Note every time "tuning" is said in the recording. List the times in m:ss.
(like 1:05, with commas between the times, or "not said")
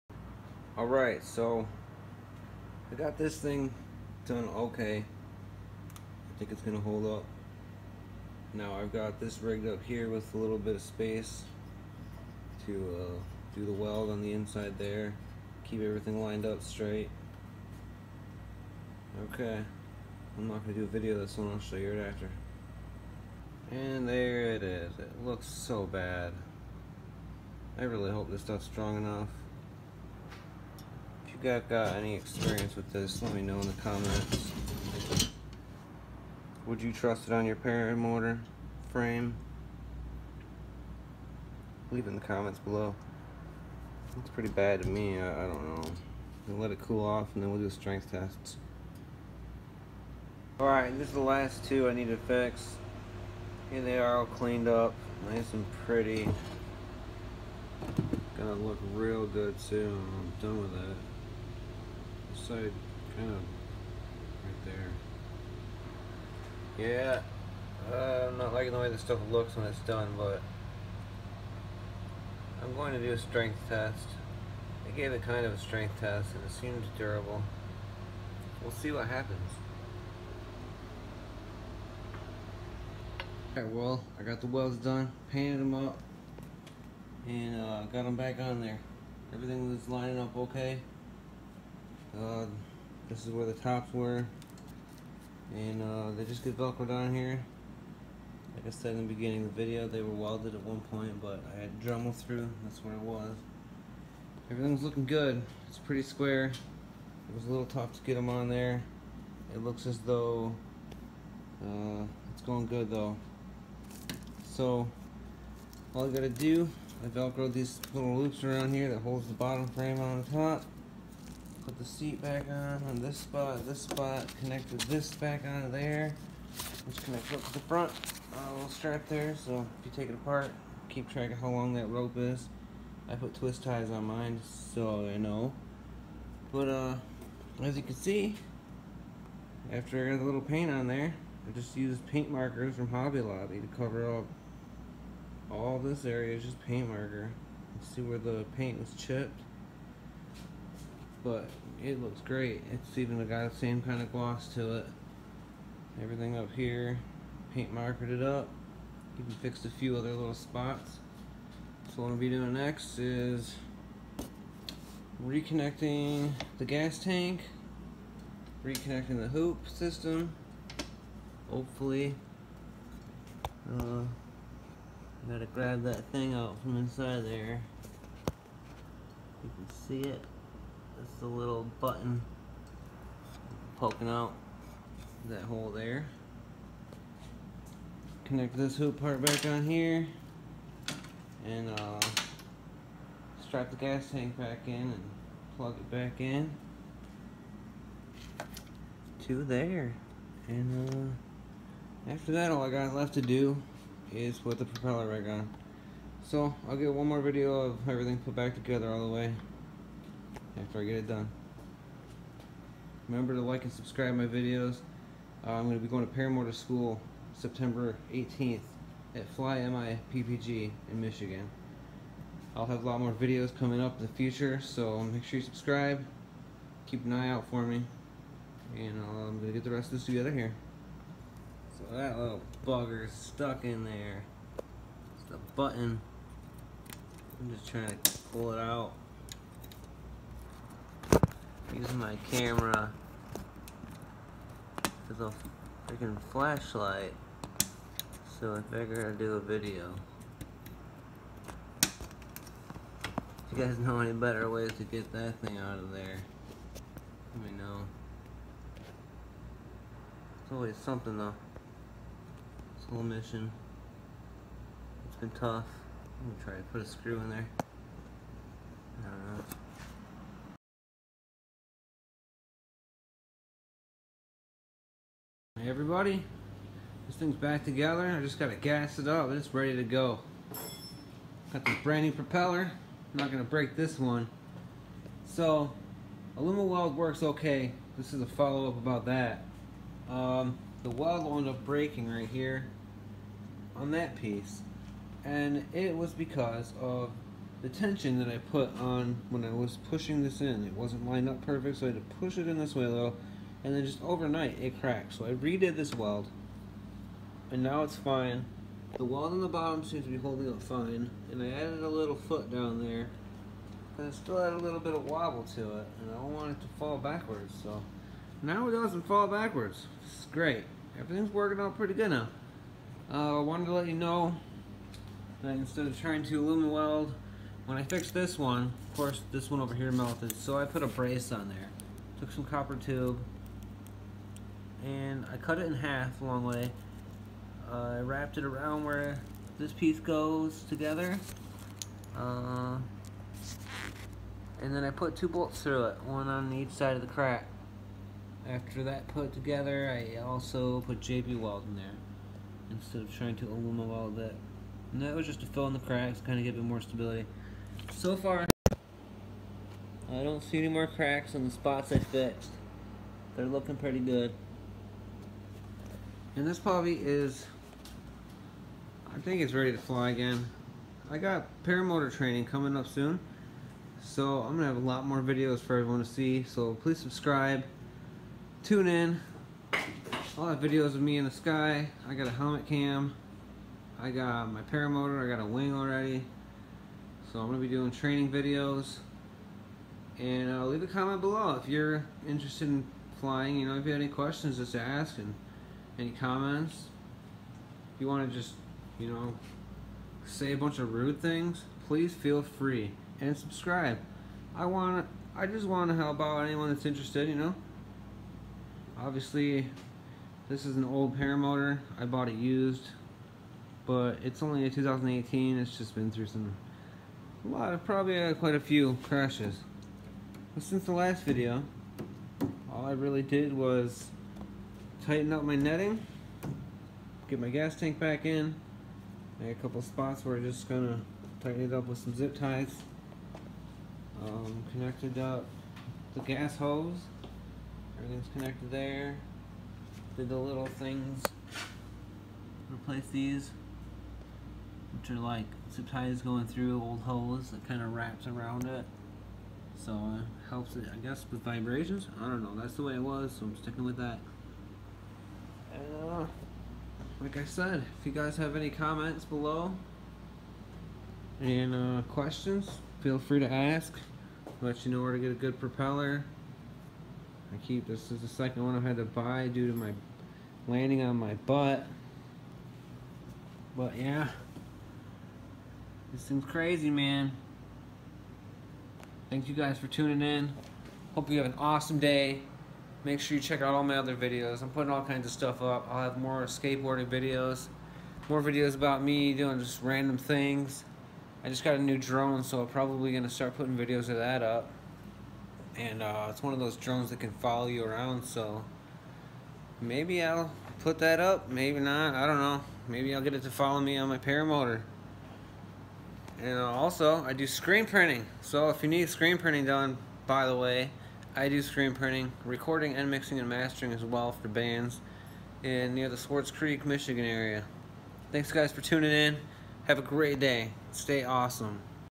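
7:59, 8:38.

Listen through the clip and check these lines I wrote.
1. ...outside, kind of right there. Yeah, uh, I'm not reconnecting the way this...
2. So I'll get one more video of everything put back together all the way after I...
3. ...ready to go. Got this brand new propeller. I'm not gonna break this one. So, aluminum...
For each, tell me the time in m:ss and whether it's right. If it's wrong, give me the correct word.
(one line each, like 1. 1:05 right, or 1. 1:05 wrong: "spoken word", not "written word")
1. 1:02 wrong: "liking", not "reconnecting"
2. 3:26 right
3. 4:39 right.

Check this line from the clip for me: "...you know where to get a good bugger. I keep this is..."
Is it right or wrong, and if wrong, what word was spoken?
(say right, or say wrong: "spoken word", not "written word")
wrong: "propeller", not "bugger".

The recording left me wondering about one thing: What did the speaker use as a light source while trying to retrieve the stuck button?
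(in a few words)
camera.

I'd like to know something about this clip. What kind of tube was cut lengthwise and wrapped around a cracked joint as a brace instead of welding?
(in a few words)
copper tube.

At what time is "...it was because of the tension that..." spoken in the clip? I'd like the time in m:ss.
4:55.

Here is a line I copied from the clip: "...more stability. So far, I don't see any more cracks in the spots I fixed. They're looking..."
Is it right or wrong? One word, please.
right.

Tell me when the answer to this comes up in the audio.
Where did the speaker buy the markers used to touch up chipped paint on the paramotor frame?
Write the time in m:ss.
2:22.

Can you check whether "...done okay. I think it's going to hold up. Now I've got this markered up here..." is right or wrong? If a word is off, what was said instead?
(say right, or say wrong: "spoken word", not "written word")
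wrong: "rigged", not "markered".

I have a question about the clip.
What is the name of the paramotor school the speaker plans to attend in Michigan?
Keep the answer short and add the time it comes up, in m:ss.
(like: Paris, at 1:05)
Fly MI PPG, at 3:39.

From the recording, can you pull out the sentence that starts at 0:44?
It's pretty bad to me, I, I don't know.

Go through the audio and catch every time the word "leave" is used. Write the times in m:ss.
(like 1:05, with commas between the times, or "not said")
0:41, 6:30.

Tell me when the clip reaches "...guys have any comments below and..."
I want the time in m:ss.
7:38.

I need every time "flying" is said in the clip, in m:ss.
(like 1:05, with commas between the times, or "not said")
6:33.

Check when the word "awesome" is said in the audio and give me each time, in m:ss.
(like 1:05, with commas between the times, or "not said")
8:01, 8:41.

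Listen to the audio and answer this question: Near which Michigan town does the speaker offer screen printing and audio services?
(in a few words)
Swartz Creek.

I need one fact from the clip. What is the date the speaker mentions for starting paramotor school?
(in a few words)
September 18th.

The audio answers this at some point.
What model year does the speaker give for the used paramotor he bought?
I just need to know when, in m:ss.
6:54.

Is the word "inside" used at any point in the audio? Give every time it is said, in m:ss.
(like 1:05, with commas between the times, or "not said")
0:14, 2:56.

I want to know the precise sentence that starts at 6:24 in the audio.
I got my paramotor, I got a wing already.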